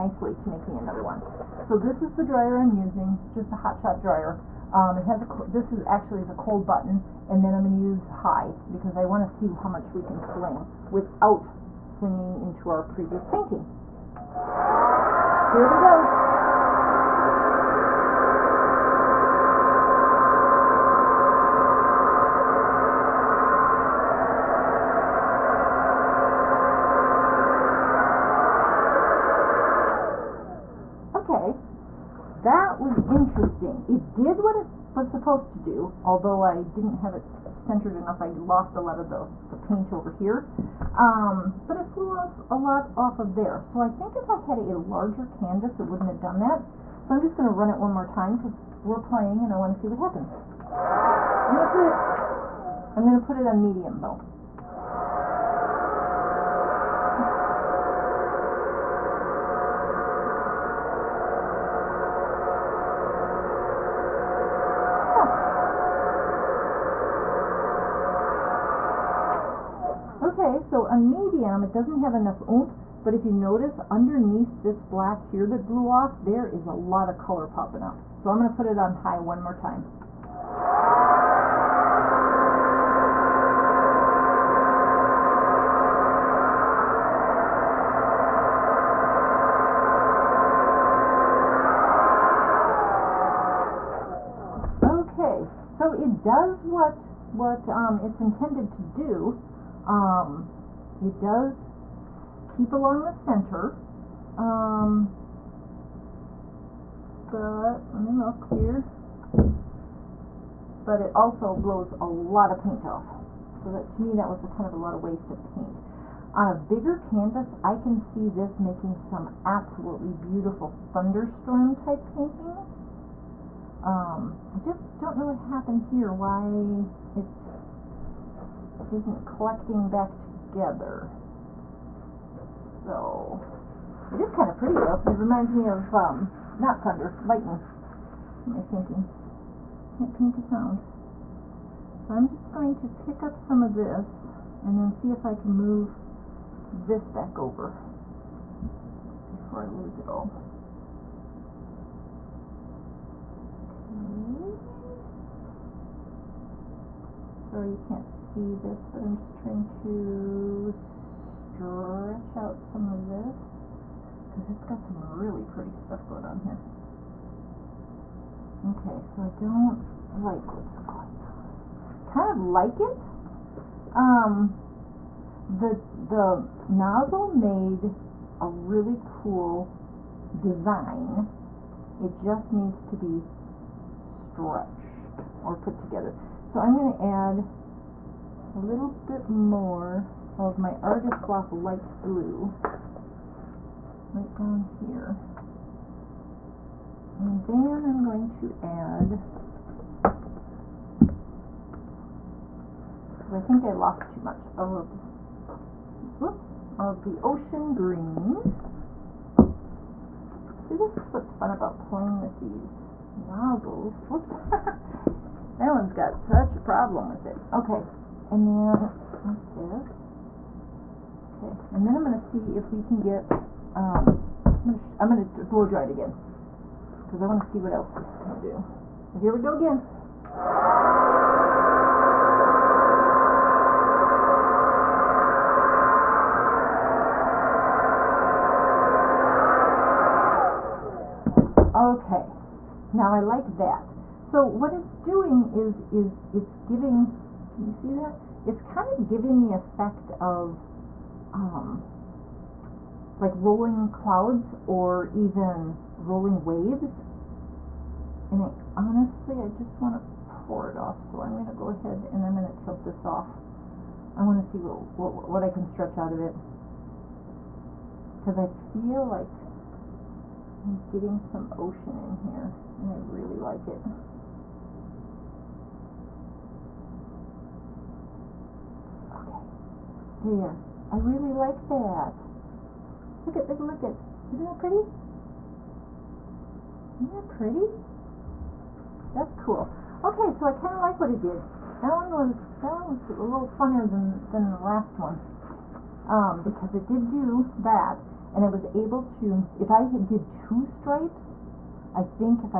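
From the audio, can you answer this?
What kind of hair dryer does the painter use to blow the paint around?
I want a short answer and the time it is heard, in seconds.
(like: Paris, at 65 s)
hot shot dryer, at 3 s.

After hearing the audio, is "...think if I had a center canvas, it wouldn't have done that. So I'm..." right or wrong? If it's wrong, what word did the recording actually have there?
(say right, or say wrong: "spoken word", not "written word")
wrong: "larger", not "center".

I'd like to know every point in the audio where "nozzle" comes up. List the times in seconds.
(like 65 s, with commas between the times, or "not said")
176 s, 213 s.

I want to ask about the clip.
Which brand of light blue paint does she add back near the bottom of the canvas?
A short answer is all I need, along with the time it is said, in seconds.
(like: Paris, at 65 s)
Artist Loft, at 190 s.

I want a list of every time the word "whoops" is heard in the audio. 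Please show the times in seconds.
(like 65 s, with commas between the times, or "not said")
206 s, 214 s.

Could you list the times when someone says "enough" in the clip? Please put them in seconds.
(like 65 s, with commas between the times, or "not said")
37 s, 72 s.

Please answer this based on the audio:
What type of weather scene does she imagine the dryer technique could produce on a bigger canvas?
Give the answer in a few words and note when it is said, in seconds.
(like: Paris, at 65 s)
thunderstorm, at 120 s.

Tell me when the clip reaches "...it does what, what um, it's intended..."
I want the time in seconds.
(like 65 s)
95 s.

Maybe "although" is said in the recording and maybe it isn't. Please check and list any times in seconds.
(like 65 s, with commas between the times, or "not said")
36 s.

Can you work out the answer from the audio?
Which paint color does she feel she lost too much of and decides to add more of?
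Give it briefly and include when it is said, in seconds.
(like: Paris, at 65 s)
ocean green, at 207 s.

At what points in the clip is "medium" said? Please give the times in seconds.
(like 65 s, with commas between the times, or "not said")
53 s, 71 s.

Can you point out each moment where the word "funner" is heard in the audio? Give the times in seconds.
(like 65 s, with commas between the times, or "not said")
293 s.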